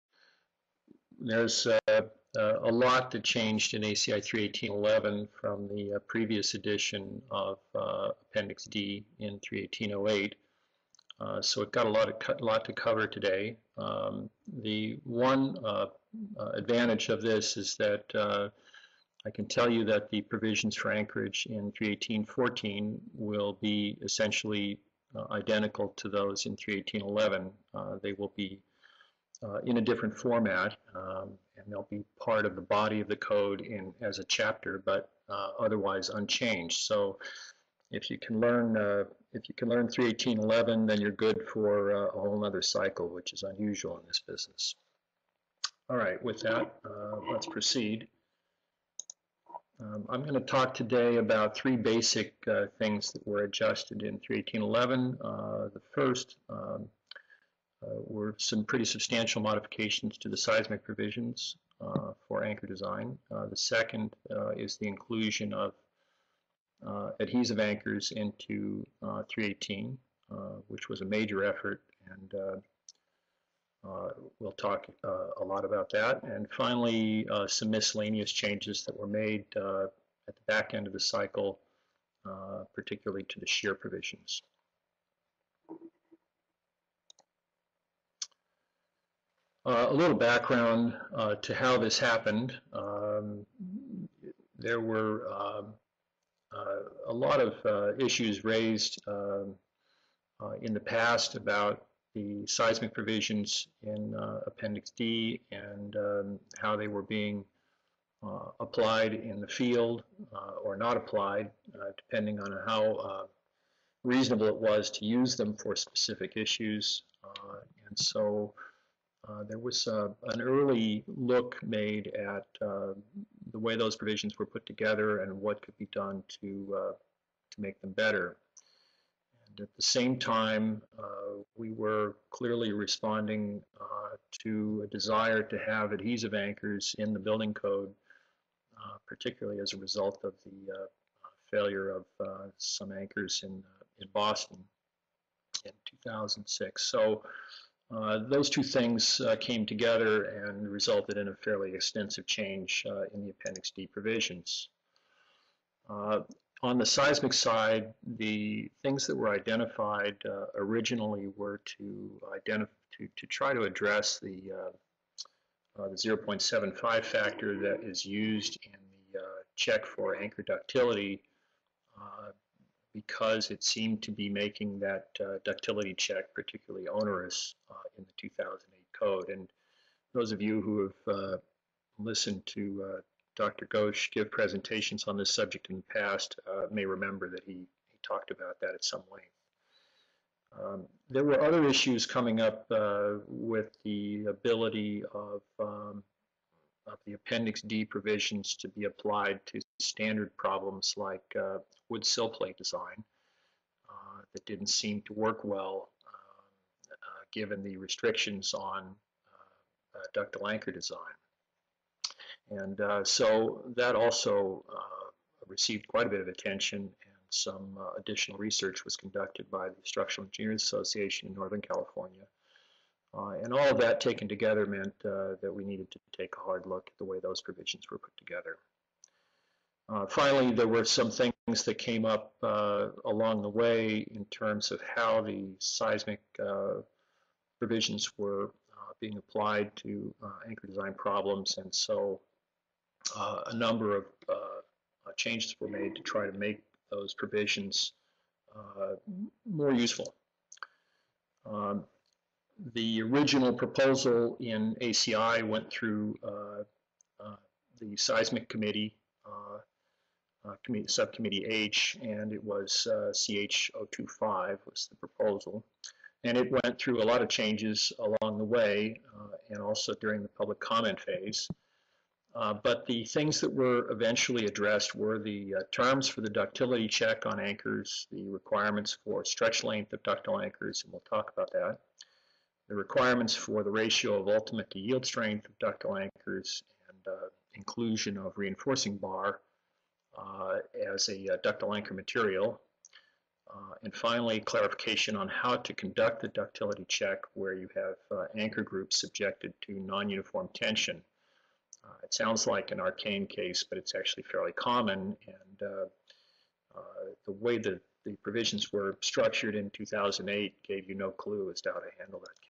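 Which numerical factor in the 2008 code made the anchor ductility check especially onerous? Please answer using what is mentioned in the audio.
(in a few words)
0.75.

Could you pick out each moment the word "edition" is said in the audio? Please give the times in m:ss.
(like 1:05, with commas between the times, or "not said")
0:06.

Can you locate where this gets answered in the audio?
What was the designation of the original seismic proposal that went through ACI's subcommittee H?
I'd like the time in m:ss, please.
4:23.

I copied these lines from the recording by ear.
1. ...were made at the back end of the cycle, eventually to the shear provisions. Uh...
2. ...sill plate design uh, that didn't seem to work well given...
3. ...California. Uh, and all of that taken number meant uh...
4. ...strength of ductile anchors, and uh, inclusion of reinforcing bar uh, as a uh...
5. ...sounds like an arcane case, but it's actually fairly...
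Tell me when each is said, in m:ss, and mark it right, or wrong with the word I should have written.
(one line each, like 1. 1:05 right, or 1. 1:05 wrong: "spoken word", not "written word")
1. 1:18 wrong: "particularly", not "eventually"
2. 3:22 right
3. 3:41 wrong: "together", not "number"
4. 4:45 right
5. 5:02 right.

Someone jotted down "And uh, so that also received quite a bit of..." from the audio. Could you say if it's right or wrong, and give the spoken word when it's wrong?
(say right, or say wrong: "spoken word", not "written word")
right.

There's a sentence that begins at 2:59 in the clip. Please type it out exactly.
And those of you who have uh, listened to uh, Dr.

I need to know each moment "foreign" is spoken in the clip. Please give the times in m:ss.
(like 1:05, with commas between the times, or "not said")
not said.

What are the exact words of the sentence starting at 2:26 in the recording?
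So uh, those two things uh, came together and resulted in a fairly extensive change uh, in the Appendix D provisions.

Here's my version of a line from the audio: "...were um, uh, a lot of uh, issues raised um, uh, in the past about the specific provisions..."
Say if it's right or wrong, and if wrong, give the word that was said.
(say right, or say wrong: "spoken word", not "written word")
wrong: "seismic", not "specific".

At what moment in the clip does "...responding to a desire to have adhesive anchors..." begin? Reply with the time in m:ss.
2:12.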